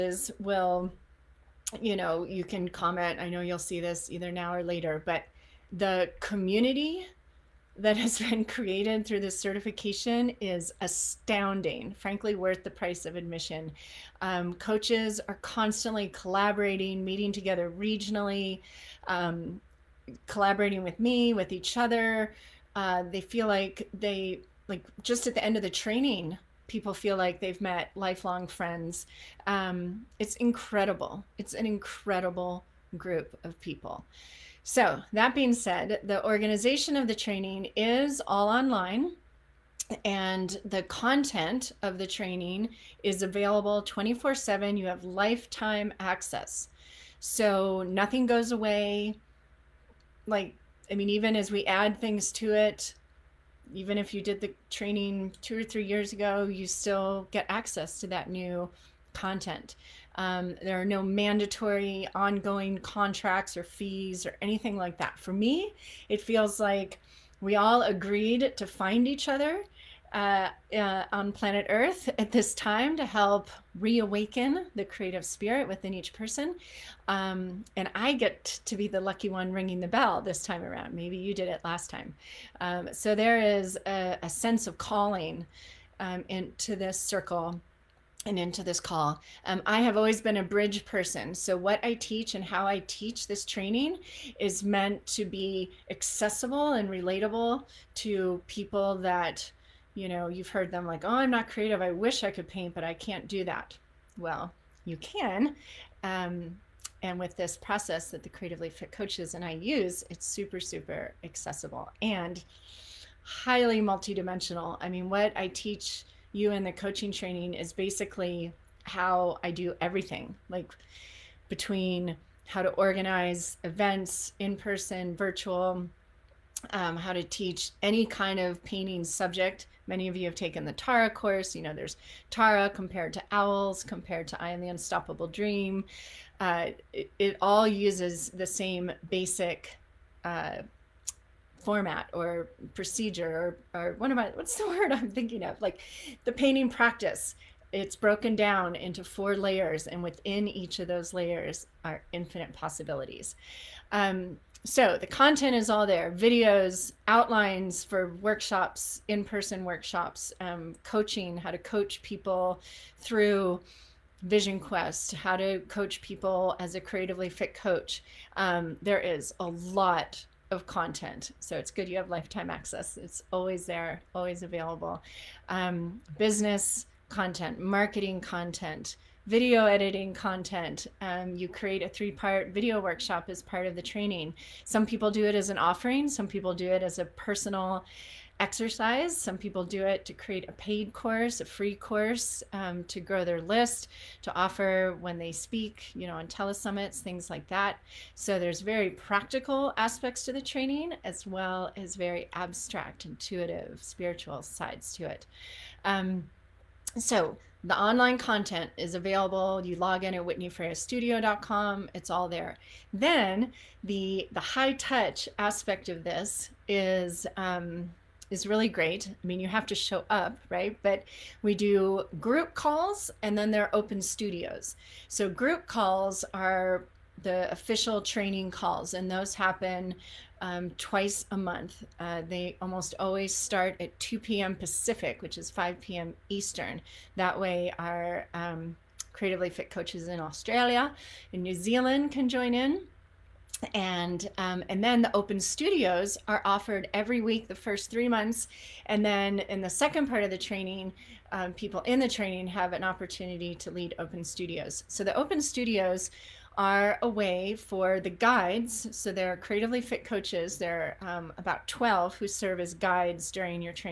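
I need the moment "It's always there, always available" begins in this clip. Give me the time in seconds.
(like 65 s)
172 s.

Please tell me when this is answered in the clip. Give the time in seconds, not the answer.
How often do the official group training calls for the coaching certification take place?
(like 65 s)
230 s.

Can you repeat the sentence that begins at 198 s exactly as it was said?
So there's very practical aspects to the training as well as very abstract, intuitive, spiritual sides to it.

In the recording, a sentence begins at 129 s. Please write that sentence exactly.
Many of you have taken the Tara course.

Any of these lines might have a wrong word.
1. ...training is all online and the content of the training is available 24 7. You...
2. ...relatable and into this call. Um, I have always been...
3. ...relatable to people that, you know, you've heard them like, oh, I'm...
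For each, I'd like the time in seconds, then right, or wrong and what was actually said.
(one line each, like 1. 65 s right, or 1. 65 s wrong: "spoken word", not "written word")
1. 37 s right
2. 86 s wrong: "circle", not "relatable"
3. 96 s right.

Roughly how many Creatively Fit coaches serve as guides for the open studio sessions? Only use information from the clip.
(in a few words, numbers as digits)
12.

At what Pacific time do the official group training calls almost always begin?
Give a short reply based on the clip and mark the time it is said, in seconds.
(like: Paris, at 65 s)
2 p.m. Pacific, at 233 s.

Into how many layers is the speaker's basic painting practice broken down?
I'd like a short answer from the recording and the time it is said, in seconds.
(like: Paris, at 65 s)
4, at 149 s.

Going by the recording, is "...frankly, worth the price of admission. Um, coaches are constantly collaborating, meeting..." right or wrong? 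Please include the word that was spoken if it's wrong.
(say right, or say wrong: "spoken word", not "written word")
right.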